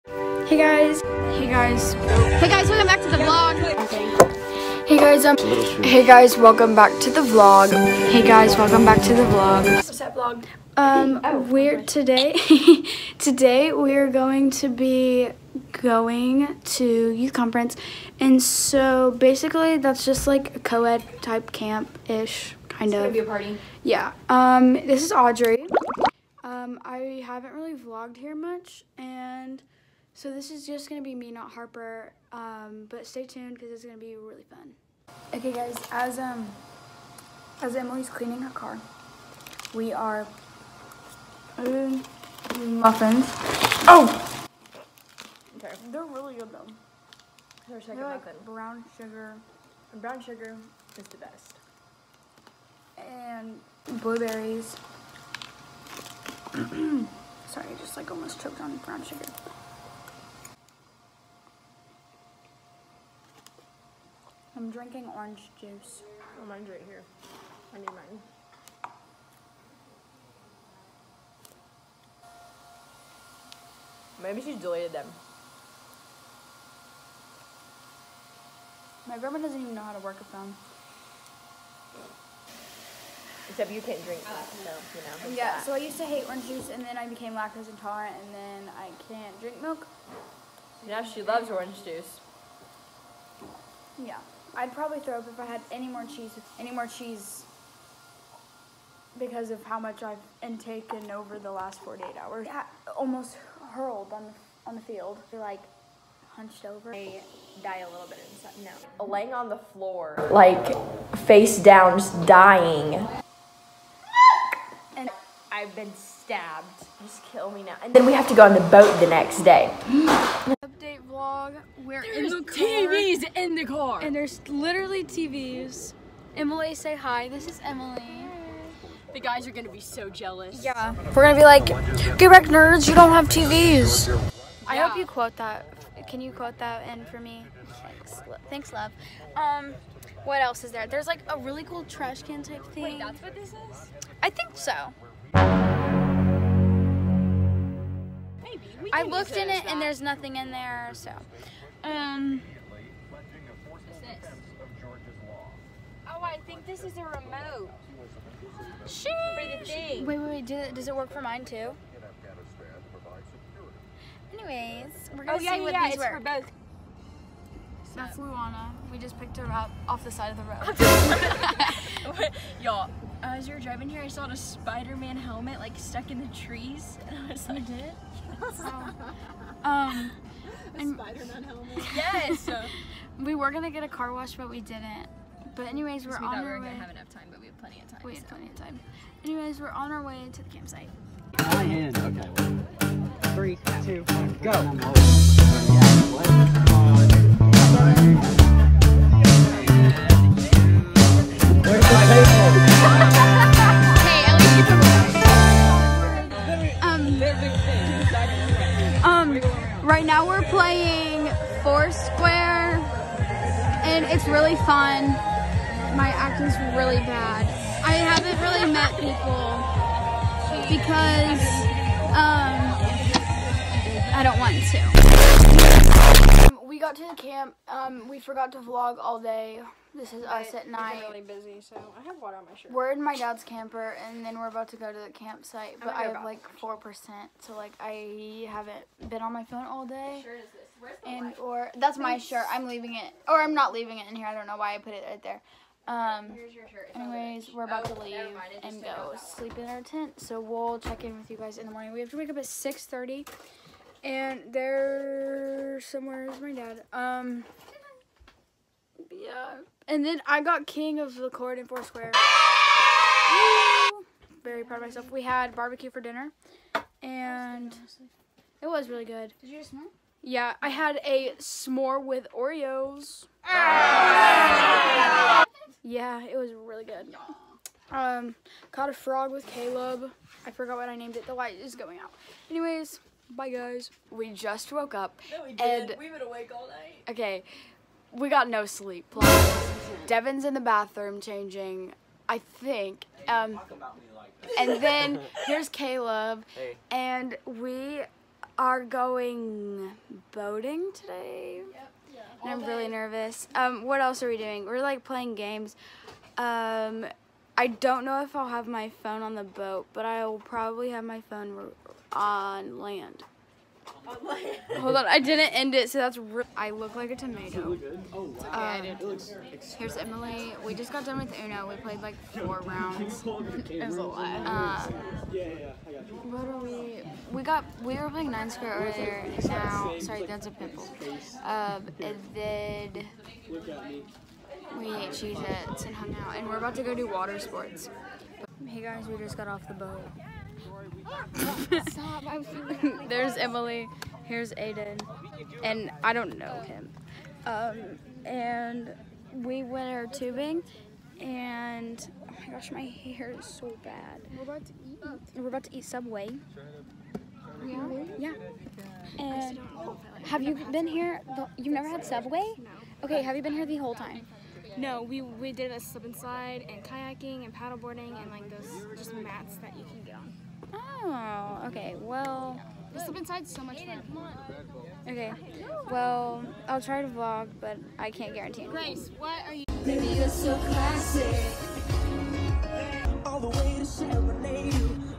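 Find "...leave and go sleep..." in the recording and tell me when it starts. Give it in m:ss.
4:08.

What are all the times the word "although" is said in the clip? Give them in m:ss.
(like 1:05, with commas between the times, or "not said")
not said.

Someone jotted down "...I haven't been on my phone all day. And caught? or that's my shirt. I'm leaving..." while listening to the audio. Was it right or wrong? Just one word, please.
wrong.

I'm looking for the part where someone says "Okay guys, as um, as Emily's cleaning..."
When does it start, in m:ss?
0:35.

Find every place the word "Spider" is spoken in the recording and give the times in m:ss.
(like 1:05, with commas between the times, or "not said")
2:54, 3:00.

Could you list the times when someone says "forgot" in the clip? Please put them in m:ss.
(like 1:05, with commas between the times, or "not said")
3:48, 4:40.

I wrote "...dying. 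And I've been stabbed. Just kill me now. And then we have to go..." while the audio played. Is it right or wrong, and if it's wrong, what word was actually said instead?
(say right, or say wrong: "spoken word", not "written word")
right.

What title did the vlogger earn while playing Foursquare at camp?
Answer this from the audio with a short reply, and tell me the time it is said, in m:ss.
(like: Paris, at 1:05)
king of the court, at 4:20.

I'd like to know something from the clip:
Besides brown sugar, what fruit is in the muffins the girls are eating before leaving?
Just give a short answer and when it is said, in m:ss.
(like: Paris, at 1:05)
blueberries, at 0:54.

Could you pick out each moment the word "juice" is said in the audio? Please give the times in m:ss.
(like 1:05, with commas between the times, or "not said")
1:05, 1:26, 1:31.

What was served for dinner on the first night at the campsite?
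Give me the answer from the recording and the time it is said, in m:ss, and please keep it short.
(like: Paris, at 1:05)
barbecue, at 4:25.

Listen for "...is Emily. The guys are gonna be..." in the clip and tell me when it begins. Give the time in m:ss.
2:07.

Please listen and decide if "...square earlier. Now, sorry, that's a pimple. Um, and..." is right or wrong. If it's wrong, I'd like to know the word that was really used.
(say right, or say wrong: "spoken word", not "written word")
right.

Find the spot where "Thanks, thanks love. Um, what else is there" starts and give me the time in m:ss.
2:17.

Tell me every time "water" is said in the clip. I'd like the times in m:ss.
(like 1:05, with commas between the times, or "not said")
3:52, 5:37.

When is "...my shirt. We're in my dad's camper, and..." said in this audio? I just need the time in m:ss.
3:52.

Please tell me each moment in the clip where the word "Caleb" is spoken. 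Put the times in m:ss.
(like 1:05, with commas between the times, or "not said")
4:39, 4:55.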